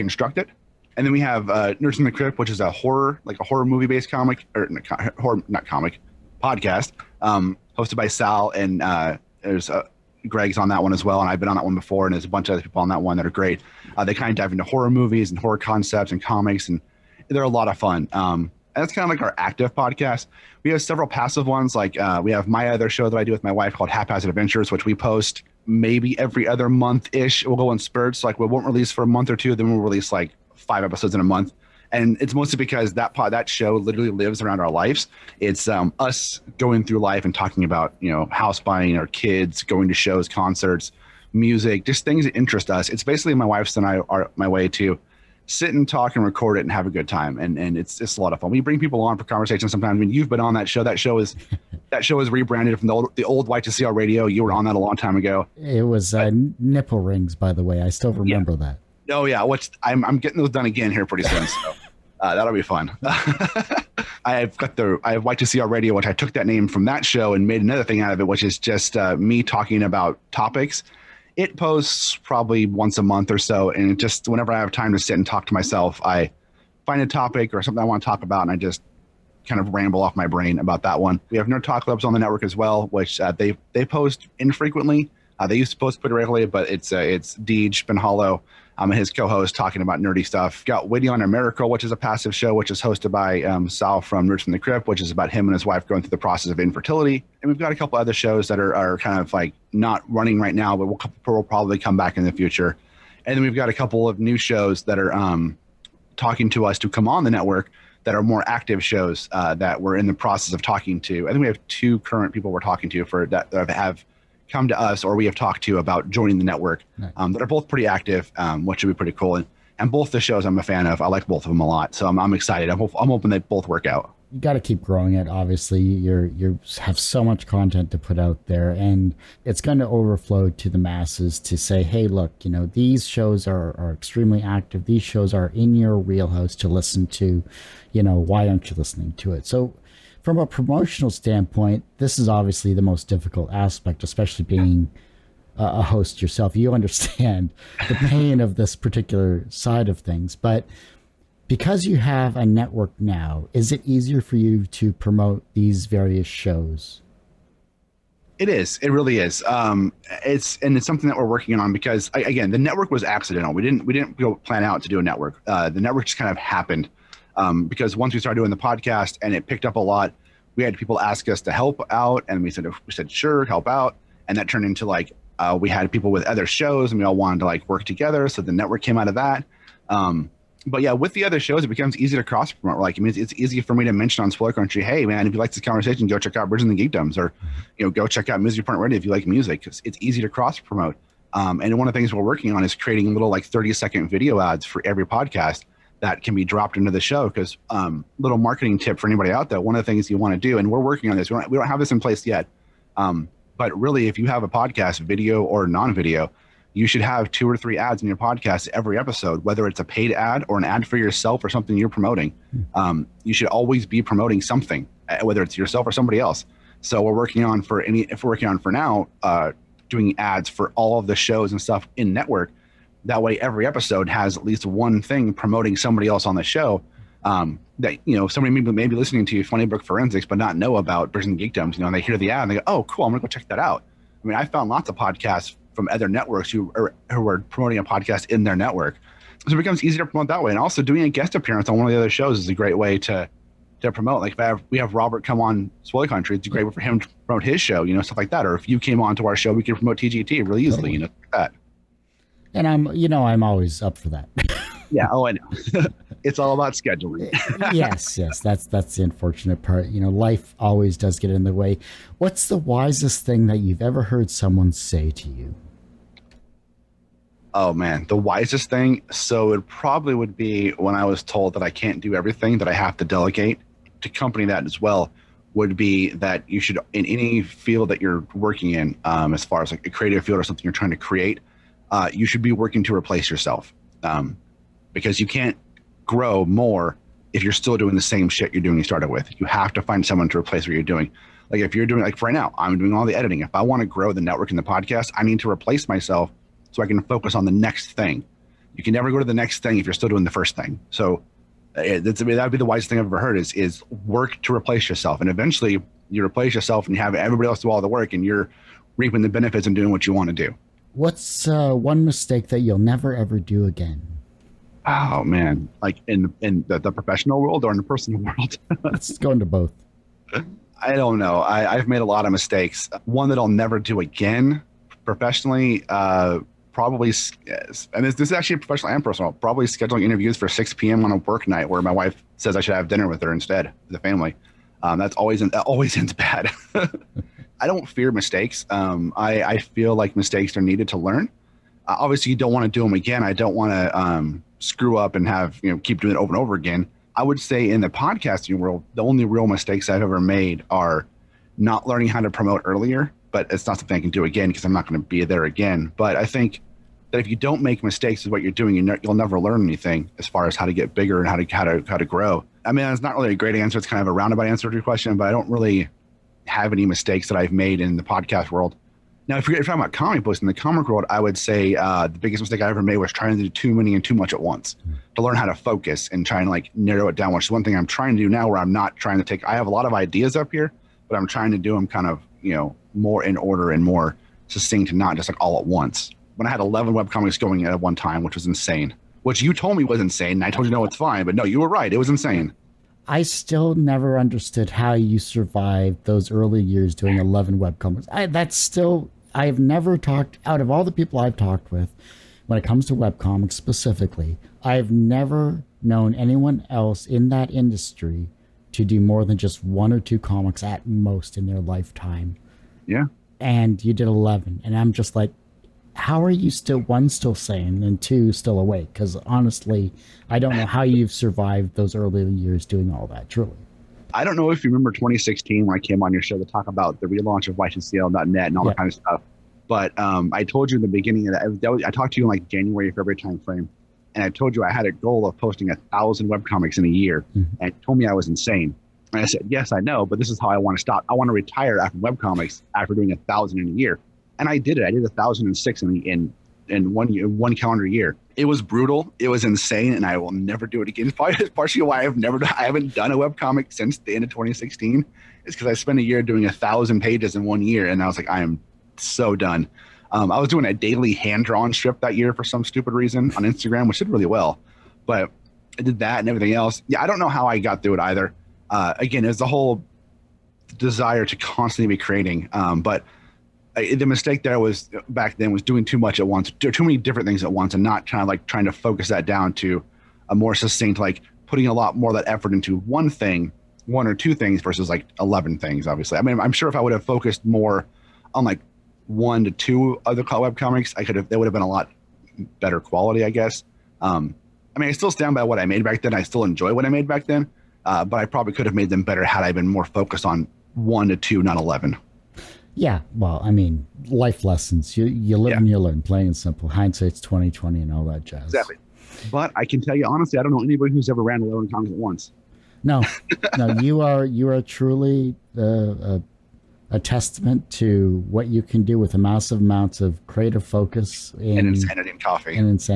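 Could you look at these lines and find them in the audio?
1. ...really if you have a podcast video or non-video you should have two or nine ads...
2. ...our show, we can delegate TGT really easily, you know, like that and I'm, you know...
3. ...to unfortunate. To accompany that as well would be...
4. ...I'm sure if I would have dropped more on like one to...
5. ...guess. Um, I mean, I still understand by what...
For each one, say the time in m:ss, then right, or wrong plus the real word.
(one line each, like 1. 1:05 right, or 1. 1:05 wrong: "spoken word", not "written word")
1. 3:23 wrong: "three", not "nine"
2. 4:09 wrong: "promote", not "delegate"
3. 4:32 wrong: "delegate", not "unfortunate"
4. 8:06 wrong: "focused", not "dropped"
5. 8:13 wrong: "stand", not "understand".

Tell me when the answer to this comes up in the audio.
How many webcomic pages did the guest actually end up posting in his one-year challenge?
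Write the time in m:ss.
7:25.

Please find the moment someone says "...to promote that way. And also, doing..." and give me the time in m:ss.
4:00.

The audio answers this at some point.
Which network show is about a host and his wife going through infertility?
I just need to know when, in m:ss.
1:30.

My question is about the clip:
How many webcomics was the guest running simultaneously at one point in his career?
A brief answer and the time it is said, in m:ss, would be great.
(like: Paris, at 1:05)
11, at 6:26.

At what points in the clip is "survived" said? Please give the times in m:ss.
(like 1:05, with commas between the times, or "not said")
6:35, 7:01.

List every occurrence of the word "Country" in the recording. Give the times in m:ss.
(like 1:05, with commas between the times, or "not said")
3:04, 4:06.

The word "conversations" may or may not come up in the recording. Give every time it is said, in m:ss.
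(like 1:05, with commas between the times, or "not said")
0:49, 3:05.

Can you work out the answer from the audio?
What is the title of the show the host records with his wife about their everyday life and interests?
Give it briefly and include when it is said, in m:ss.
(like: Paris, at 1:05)
Haphazard Adventures, at 0:23.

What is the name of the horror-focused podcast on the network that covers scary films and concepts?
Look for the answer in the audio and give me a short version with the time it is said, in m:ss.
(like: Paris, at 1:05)
Nerds in the Crypt, at 0:01.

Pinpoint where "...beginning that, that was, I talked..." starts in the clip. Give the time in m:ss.
7:10.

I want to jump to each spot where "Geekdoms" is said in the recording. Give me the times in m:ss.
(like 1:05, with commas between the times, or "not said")
3:06, 3:51.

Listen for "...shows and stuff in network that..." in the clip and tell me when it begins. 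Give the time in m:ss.
3:41.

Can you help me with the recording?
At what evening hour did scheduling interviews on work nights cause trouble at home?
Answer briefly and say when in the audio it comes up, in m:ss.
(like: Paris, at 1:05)
6 p.m., at 5:30.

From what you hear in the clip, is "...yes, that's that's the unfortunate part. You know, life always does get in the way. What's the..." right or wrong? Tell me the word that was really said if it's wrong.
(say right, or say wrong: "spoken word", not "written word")
right.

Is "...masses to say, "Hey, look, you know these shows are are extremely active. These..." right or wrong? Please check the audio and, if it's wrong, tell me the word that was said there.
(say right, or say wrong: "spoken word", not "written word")
right.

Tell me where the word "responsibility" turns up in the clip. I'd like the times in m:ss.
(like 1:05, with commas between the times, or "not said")
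not said.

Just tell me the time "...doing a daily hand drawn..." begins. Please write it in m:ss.
7:40.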